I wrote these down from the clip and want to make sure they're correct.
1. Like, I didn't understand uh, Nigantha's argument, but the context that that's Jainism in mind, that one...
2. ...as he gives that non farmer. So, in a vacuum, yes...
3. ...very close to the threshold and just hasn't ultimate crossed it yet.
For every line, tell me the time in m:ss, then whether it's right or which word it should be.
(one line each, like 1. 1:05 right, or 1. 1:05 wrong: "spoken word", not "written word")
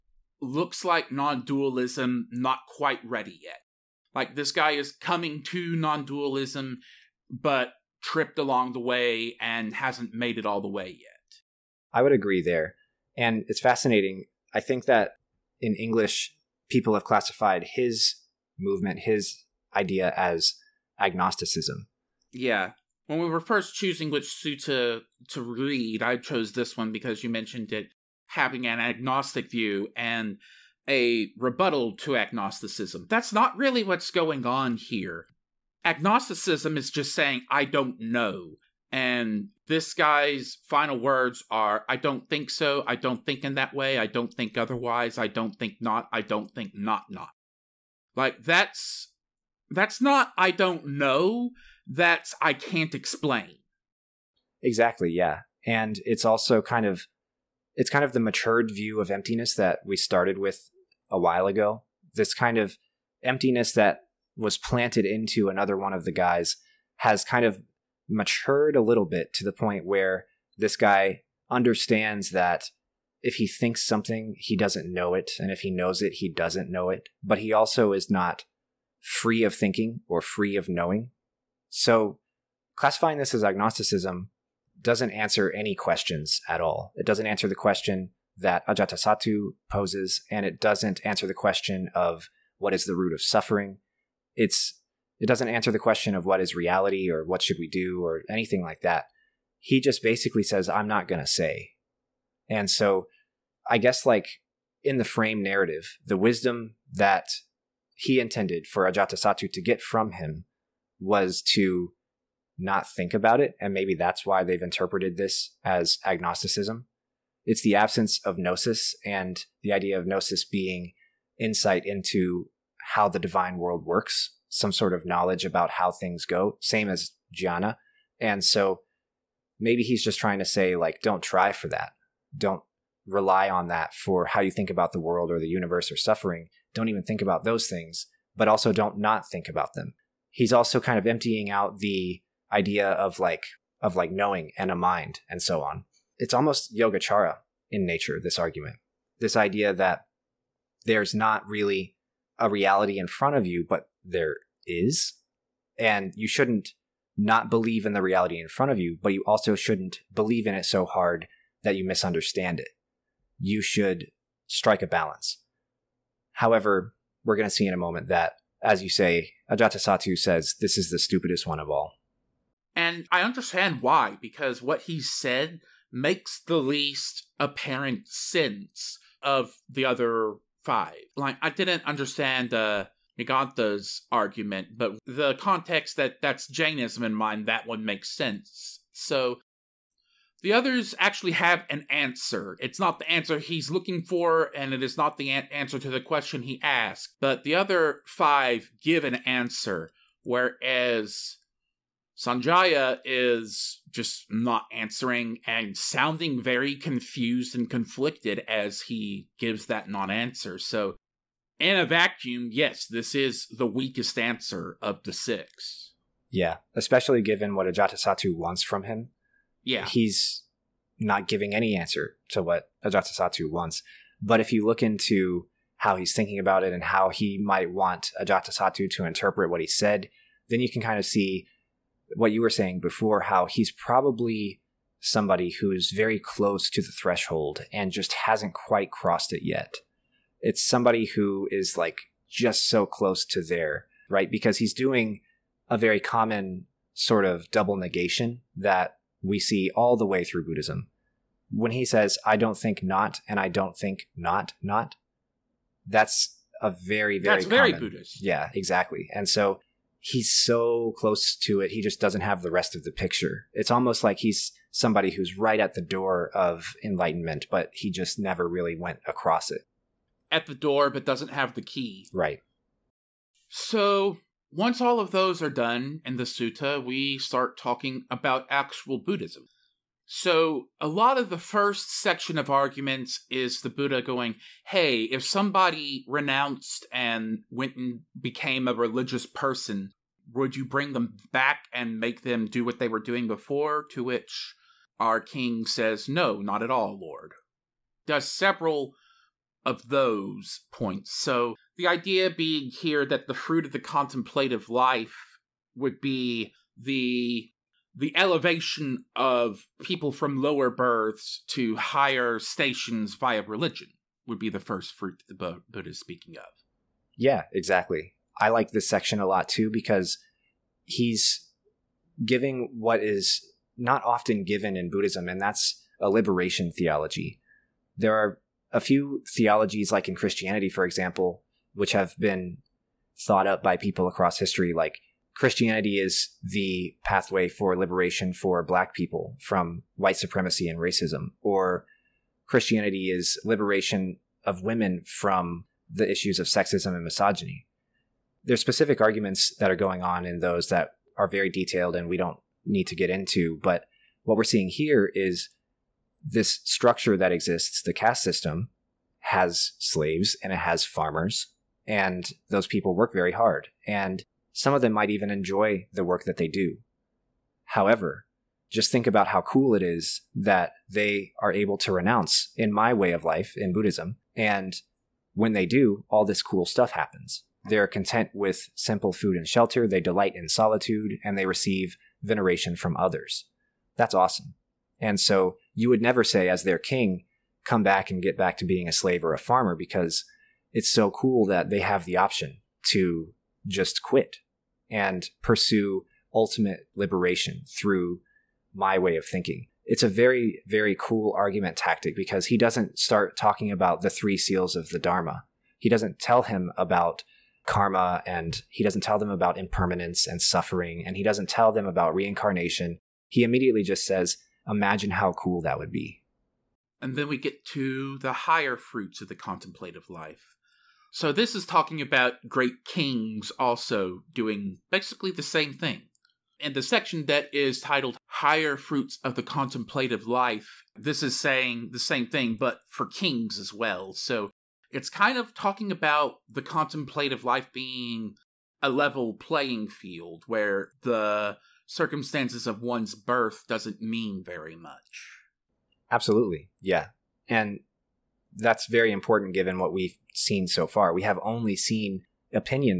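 1. 3:01 right
2. 3:28 wrong: "answer", not "farmer"
3. 3:55 wrong: "quite", not "ultimate".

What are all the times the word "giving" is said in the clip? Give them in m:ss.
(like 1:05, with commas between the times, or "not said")
3:41, 5:22.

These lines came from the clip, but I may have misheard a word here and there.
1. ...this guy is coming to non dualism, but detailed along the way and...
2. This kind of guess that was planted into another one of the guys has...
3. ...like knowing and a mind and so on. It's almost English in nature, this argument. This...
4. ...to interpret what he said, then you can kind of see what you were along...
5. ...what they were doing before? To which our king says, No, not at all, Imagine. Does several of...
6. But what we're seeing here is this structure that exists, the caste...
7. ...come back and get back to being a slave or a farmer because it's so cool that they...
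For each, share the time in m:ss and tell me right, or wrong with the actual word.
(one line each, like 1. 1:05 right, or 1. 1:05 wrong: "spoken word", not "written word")
1. 0:04 wrong: "tripped", not "detailed"
2. 1:02 wrong: "emptiness", not "guess"
3. 2:23 wrong: "Yogacara", not "English"
4. 3:48 wrong: "saying", not "along"
5. 4:52 wrong: "Lord", not "Imagine"
6. 5:53 right
7. 6:27 right.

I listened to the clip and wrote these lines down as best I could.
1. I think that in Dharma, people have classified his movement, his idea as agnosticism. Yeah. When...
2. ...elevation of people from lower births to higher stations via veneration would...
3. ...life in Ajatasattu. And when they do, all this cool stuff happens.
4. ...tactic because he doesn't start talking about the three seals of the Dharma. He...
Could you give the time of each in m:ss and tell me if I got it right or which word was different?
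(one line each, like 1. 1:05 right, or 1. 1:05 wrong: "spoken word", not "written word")
1. 0:14 wrong: "English", not "Dharma"
2. 5:08 wrong: "religion", not "veneration"
3. 6:13 wrong: "Buddhism", not "Ajatasattu"
4. 6:41 right.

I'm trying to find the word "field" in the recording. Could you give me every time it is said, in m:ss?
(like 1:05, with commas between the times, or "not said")
7:19.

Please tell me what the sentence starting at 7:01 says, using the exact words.
So this is talking about great kings also doing basically the same thing.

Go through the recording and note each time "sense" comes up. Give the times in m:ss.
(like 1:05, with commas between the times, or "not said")
2:58, 3:08.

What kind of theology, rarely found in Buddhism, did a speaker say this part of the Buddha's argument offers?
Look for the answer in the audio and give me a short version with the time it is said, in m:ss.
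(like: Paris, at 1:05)
Liberation theology, at 5:26.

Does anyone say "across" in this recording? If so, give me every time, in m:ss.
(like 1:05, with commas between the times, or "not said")
4:29, 5:34.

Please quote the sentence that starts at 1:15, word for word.
And if he knows it, he doesn't know it.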